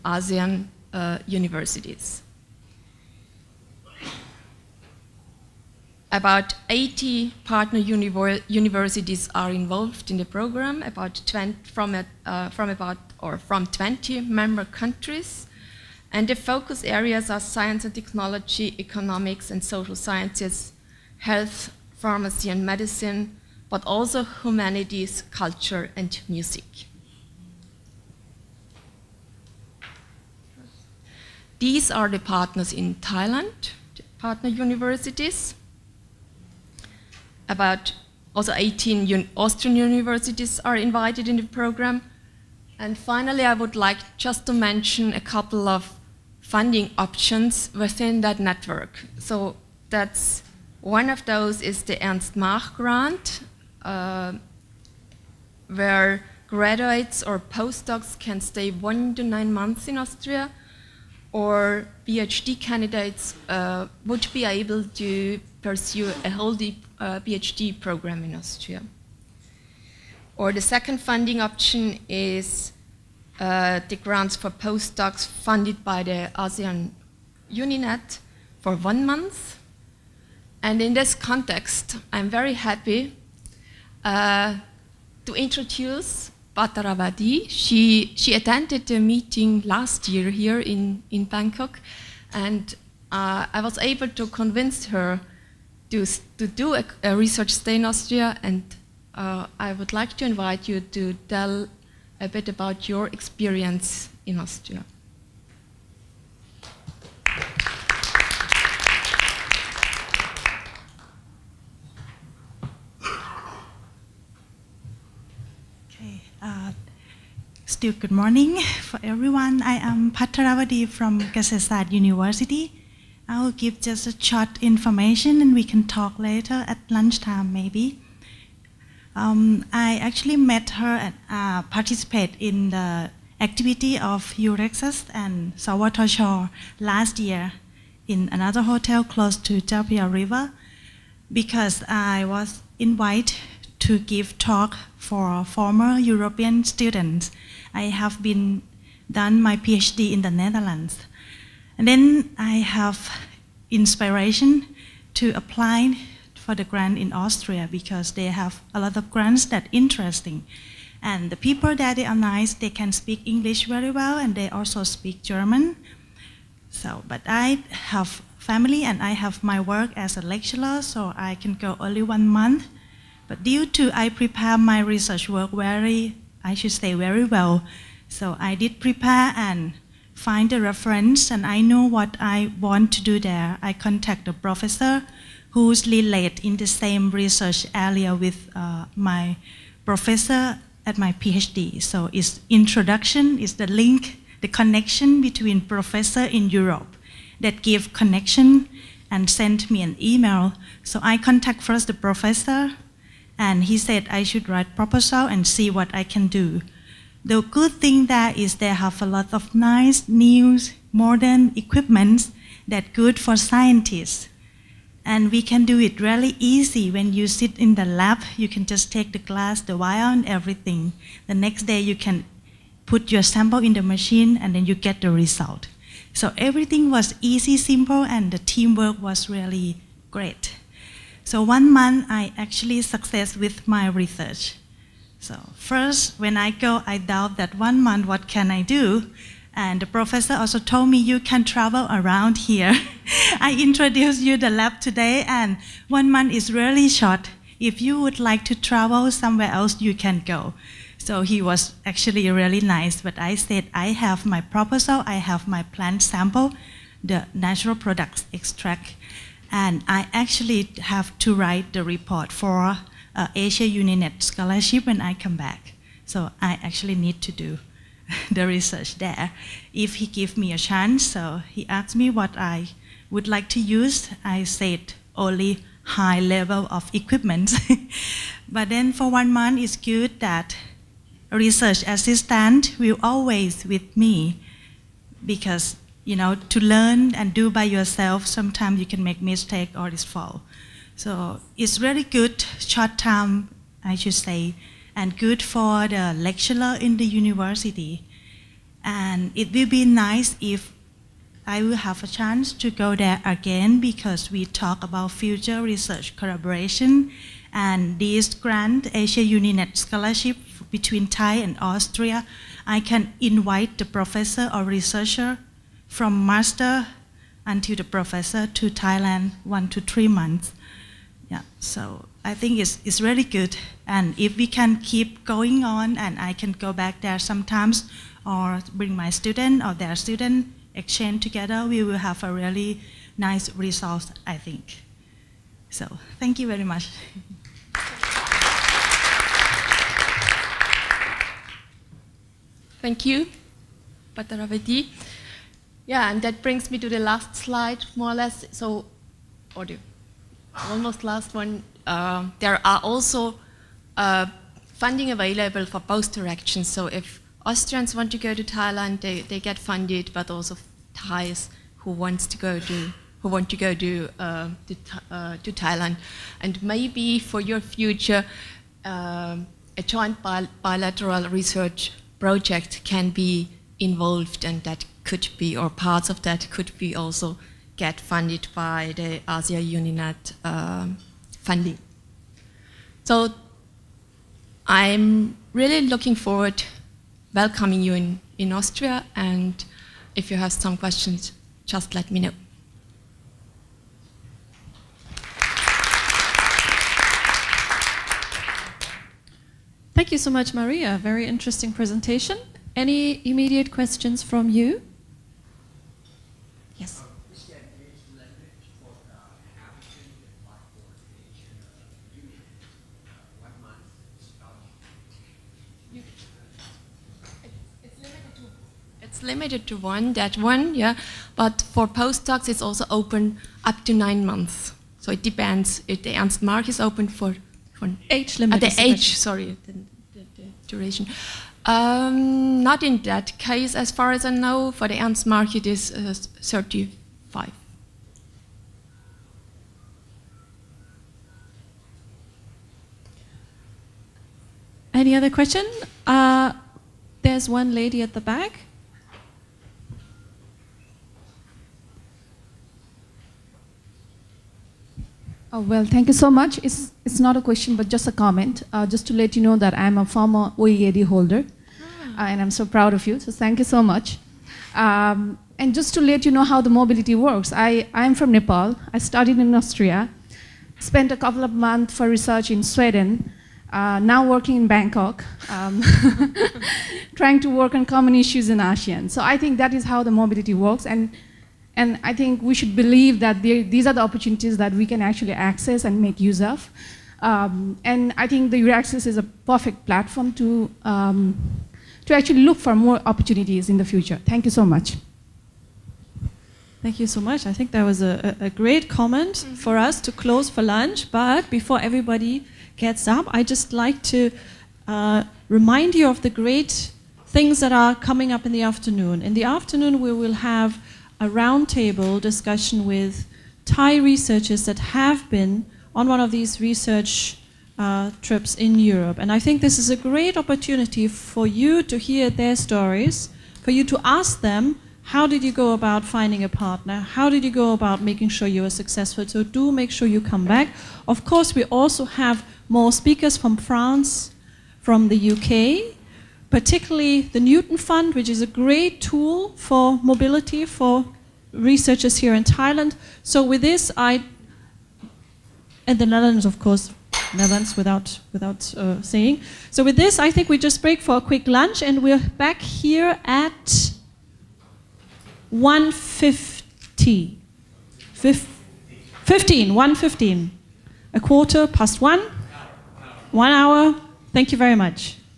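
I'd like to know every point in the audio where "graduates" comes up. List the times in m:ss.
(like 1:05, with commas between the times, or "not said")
0:56.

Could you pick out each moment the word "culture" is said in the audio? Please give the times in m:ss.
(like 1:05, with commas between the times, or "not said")
0:25.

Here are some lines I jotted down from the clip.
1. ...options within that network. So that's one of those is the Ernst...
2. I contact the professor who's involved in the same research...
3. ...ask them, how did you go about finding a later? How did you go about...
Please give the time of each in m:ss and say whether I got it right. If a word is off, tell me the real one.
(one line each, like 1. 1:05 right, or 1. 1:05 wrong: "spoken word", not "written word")
1. 0:46 right
2. 3:03 wrong: "related", not "involved"
3. 8:44 wrong: "partner", not "later".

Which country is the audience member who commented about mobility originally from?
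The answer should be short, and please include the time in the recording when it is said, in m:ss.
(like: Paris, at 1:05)
Nepal, at 7:48.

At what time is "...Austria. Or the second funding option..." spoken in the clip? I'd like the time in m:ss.
1:08.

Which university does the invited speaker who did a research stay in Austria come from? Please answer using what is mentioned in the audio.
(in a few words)
Kasetsart University.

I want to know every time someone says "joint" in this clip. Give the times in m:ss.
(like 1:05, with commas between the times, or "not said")
6:09.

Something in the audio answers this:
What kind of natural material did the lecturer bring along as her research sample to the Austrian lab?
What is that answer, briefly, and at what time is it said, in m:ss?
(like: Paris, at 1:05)
plant sample, at 4:15.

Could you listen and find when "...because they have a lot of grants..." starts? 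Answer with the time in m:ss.
2:37.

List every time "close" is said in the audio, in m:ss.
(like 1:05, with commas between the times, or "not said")
2:19, 8:20.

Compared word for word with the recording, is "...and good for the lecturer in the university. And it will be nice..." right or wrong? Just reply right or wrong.
right.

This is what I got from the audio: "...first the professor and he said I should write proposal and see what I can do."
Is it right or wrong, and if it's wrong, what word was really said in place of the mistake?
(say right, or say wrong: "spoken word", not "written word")
right.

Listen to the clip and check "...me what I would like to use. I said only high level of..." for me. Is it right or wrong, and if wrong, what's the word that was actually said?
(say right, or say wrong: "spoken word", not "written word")
right.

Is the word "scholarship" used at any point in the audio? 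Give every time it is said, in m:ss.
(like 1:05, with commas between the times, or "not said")
4:24, 5:09.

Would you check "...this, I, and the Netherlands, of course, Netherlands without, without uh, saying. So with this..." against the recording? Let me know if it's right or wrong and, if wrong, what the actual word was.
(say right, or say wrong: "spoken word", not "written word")
right.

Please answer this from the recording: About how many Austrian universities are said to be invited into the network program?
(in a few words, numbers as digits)
18.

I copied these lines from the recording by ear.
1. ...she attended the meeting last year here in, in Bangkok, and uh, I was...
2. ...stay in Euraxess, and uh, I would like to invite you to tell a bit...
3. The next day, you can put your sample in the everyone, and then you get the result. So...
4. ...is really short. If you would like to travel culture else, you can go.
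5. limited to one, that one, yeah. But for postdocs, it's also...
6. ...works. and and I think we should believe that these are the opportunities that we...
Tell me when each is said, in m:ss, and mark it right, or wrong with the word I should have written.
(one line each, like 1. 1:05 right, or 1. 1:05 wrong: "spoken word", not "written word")
1. 1:28 right
2. 1:37 wrong: "Austria", not "Euraxess"
3. 3:41 wrong: "machine", not "everyone"
4. 4:06 wrong: "somewhere", not "culture"
5. 6:59 right
6. 8:00 right.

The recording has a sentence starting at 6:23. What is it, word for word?
So I'm really looking forward welcoming you in, in Austria and if you have some questions, just let me know.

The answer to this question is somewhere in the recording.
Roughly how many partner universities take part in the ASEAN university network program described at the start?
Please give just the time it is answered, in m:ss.
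0:06.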